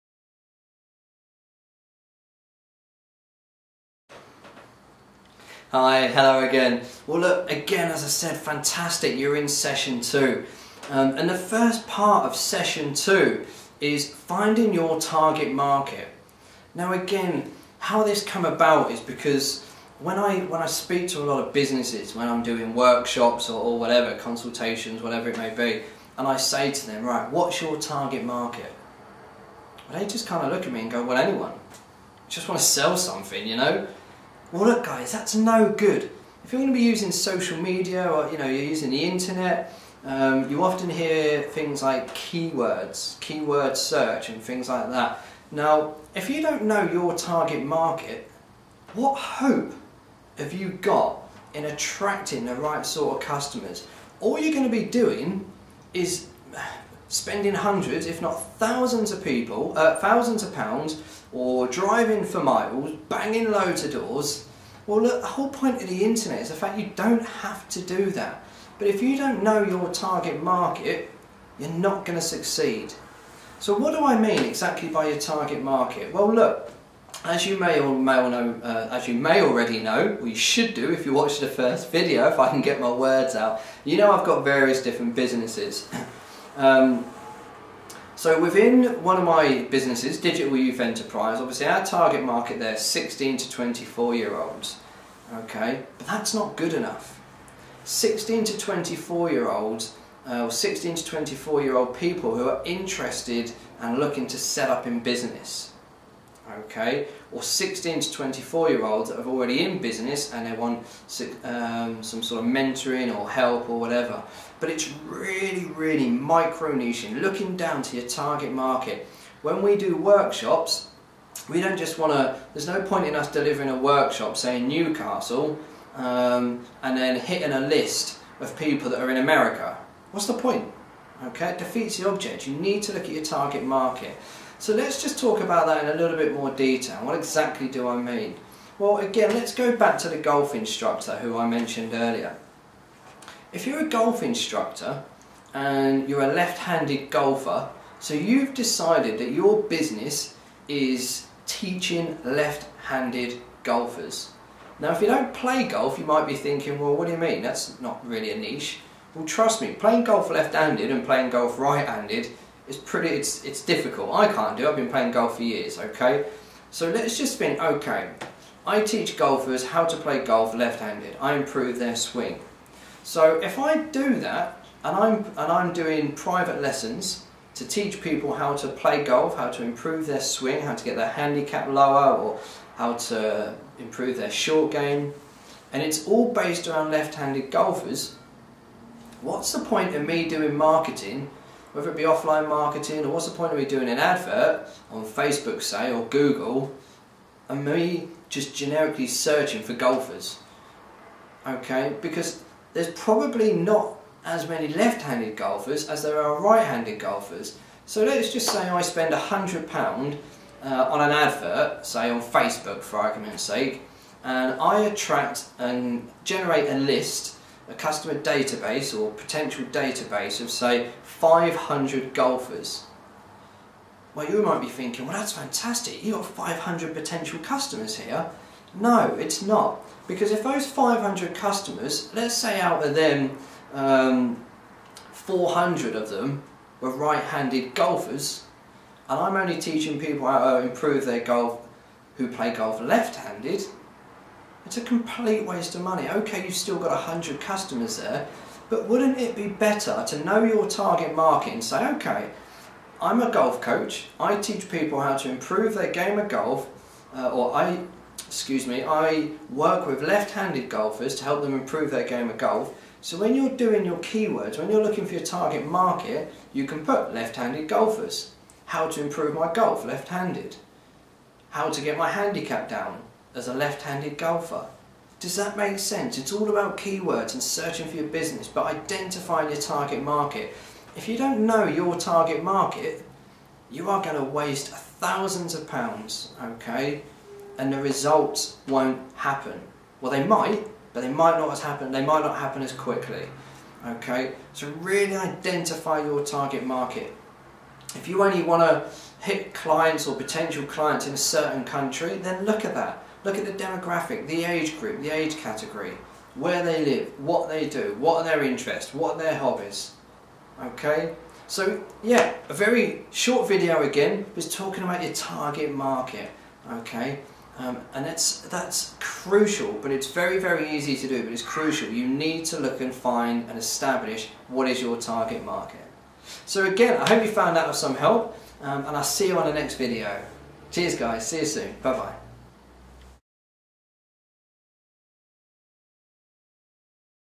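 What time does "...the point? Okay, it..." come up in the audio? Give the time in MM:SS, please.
02:10.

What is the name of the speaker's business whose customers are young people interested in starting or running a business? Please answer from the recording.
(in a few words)
Digital Youth Enterprise.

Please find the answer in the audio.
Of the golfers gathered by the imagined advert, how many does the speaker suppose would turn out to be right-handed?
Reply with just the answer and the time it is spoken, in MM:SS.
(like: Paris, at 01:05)
400, at 03:55.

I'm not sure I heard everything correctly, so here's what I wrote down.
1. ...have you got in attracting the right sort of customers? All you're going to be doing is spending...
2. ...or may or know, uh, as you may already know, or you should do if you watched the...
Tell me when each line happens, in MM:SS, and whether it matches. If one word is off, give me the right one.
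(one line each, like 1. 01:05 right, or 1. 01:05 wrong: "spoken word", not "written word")
1. 00:50 right
2. 01:17 right.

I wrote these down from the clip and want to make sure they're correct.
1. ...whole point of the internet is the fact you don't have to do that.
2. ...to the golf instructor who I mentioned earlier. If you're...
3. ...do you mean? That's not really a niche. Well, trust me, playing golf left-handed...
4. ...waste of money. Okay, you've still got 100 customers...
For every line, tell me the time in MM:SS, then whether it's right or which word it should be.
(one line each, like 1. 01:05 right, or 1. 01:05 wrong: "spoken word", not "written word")
1. 01:05 right
2. 02:20 right
3. 02:37 right
4. 04:05 right.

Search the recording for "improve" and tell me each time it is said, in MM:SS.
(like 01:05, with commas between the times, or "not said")
02:51, 02:59, 03:03, 04:00, 04:15, 04:21, 04:29.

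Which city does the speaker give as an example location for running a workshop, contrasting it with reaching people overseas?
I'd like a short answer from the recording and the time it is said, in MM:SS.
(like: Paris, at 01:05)
Newcastle, at 02:04.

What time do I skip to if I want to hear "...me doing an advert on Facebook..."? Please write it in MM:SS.
03:13.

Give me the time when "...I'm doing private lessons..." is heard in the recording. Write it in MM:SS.
02:55.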